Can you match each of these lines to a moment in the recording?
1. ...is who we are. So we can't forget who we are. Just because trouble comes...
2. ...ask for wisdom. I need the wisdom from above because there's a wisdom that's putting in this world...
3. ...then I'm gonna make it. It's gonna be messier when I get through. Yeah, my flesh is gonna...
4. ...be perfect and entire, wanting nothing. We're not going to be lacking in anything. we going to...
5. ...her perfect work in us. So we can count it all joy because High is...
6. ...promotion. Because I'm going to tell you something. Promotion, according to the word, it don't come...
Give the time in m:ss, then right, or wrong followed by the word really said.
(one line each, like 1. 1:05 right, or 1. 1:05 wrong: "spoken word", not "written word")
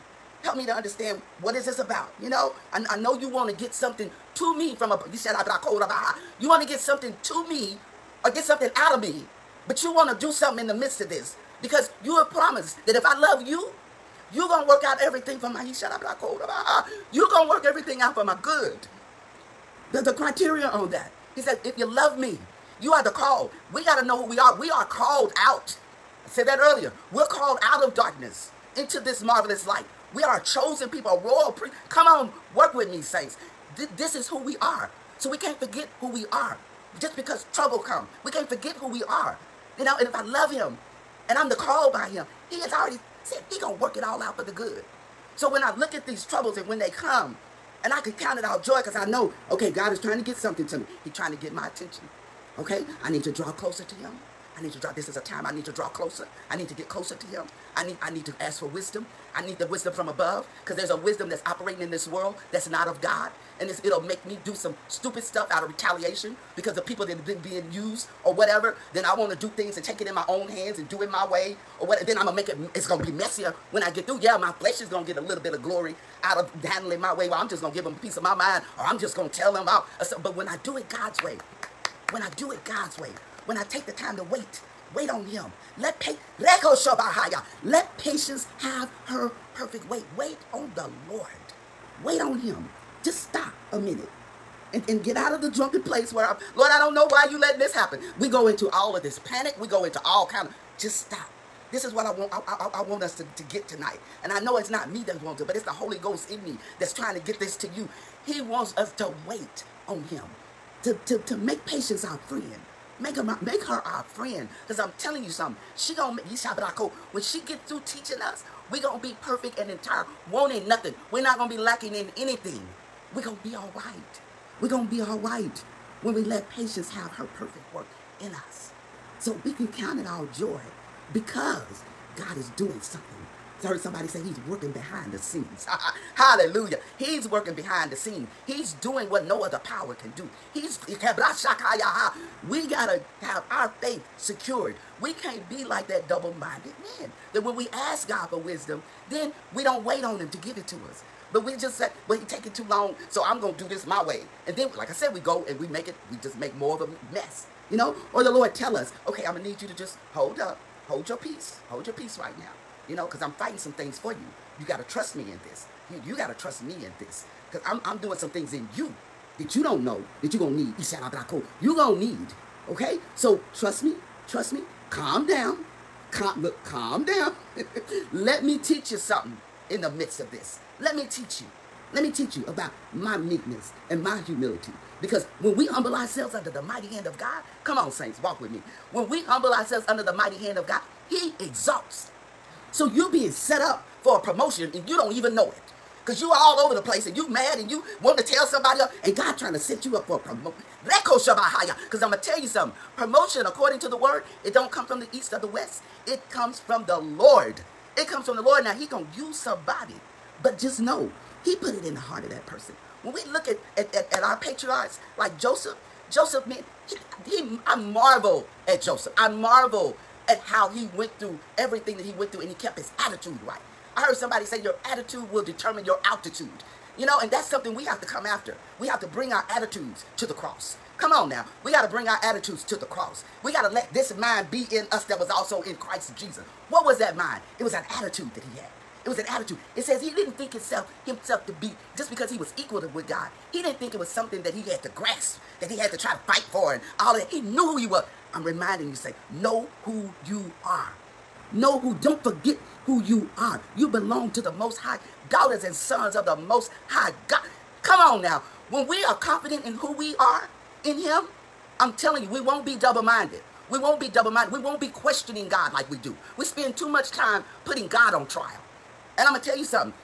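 1. 0:34 right
2. 0:58 wrong: "operating", not "putting"
3. 1:12 right
4. 1:59 right
5. 2:07 wrong: "God", not "High"
6. 3:20 right.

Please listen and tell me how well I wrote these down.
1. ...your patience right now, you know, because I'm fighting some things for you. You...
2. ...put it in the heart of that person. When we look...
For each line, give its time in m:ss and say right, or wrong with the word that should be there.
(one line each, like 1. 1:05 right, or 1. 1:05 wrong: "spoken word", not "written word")
1. 2:41 wrong: "peace", not "patience"
2. 3:31 right.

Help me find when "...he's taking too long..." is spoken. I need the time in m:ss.
2:32.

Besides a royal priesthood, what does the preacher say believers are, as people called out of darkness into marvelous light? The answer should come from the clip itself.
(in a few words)
a chosen people.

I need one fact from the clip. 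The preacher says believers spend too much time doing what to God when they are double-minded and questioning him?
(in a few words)
putting God on trial.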